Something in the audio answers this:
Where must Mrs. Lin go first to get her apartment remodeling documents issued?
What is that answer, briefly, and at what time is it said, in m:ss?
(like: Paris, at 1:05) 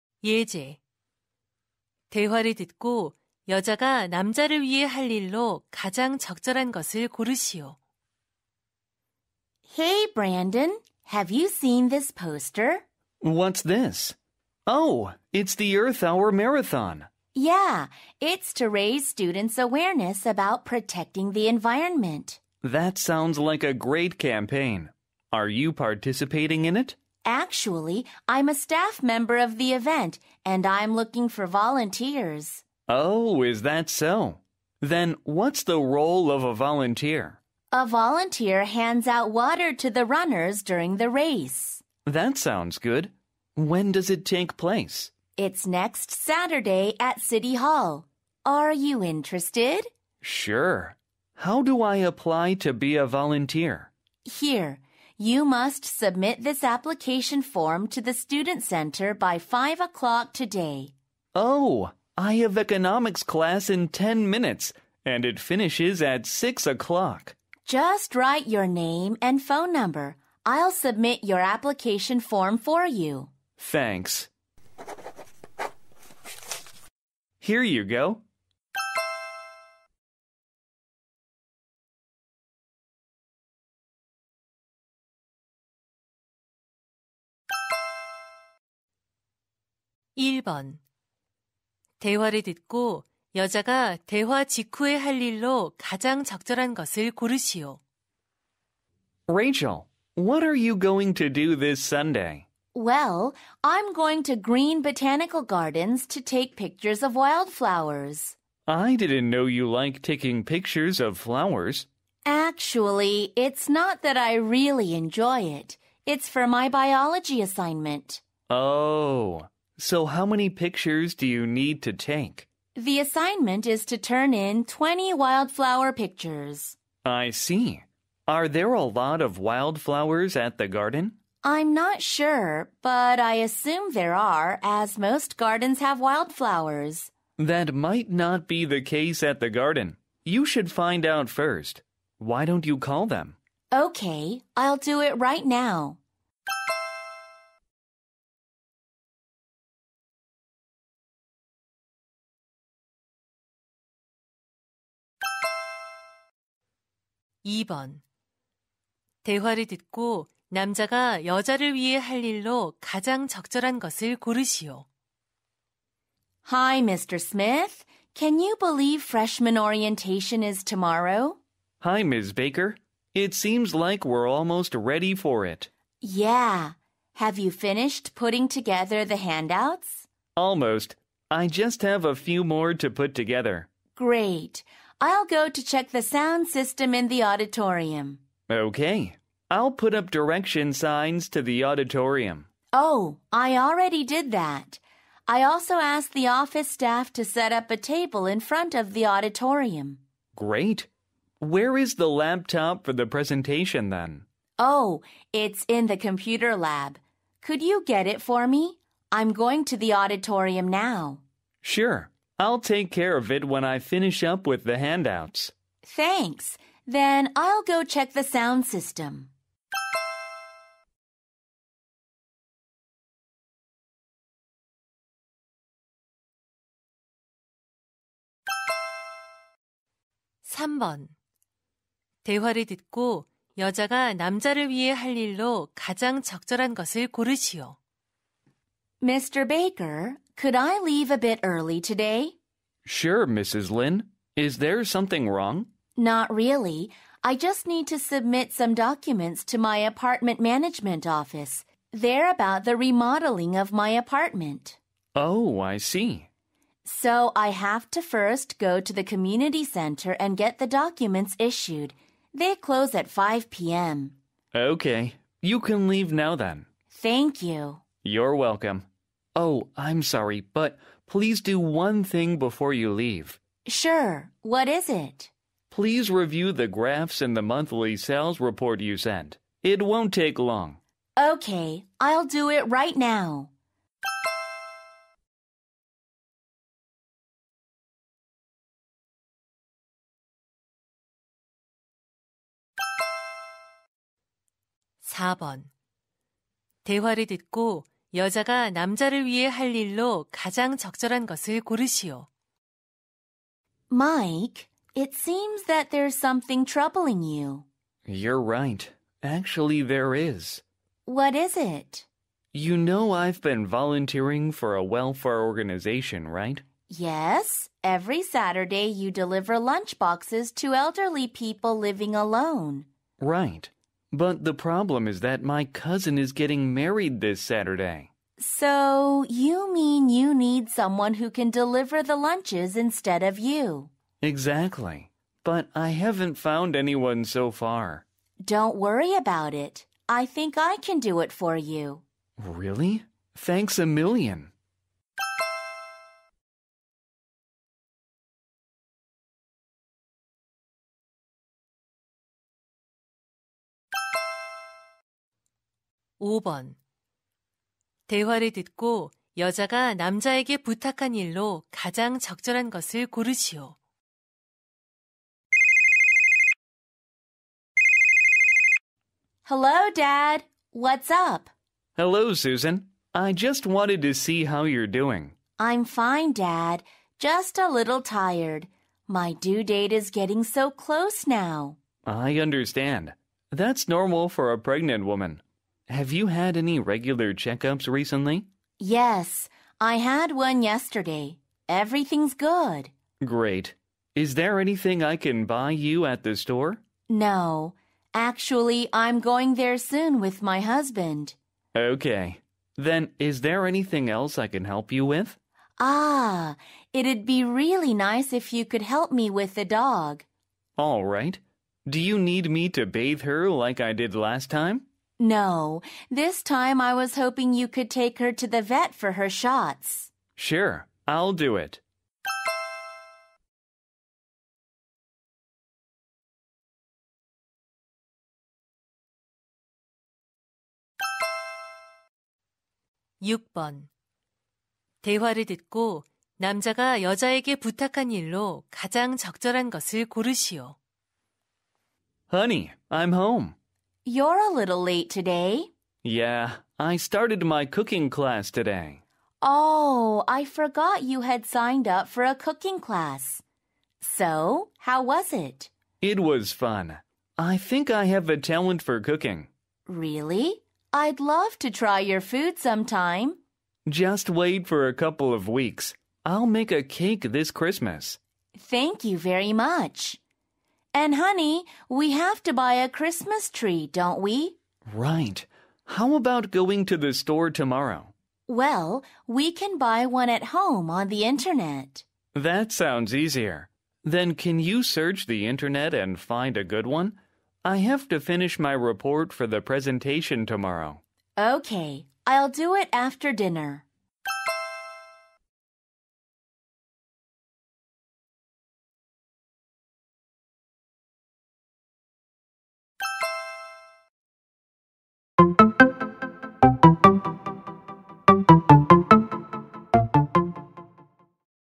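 community center, at 4:19.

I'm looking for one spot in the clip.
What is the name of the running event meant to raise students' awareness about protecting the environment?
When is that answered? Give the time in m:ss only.
0:15.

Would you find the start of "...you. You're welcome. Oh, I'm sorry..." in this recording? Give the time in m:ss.
4:27.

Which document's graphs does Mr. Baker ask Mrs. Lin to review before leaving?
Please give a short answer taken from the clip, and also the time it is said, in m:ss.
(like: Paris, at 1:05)
monthly sales report, at 4:37.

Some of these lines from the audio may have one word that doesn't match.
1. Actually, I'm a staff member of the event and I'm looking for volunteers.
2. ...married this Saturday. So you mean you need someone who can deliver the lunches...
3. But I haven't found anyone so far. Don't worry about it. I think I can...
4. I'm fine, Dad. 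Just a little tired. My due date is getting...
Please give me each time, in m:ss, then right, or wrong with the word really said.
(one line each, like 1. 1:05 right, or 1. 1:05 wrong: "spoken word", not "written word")
1. 0:27 right
2. 5:26 right
3. 5:35 right
4. 6:15 right.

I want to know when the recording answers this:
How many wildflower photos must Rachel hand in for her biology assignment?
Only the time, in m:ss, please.
2:04.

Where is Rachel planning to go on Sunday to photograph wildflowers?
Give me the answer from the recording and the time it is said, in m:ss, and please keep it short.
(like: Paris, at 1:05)
Green Botanical Gardens, at 1:44.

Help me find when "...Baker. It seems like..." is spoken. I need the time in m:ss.
2:52.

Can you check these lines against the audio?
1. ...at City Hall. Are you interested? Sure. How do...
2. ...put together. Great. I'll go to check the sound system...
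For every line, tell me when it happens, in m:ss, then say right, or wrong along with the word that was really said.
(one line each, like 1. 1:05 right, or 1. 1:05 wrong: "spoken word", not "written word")
1. 0:46 right
2. 3:02 right.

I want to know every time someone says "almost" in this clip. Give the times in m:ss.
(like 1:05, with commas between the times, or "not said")
2:54, 3:00.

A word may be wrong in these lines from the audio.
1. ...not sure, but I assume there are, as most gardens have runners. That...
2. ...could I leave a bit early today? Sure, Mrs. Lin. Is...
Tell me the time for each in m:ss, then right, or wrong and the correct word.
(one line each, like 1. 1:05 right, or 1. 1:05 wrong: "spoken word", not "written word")
1. 2:11 wrong: "wildflowers", not "runners"
2. 4:00 right.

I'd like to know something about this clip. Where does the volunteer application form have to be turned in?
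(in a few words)
Student Center.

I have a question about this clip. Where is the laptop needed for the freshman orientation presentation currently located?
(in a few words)
computer lab.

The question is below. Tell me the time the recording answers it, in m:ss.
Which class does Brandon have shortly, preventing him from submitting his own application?
1:02.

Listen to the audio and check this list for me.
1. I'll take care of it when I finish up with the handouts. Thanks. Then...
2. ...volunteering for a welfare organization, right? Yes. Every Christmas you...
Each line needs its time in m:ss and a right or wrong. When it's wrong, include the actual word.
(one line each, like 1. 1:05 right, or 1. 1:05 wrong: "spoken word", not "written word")
1. 3:32 right
2. 5:13 wrong: "Saturday", not "Christmas".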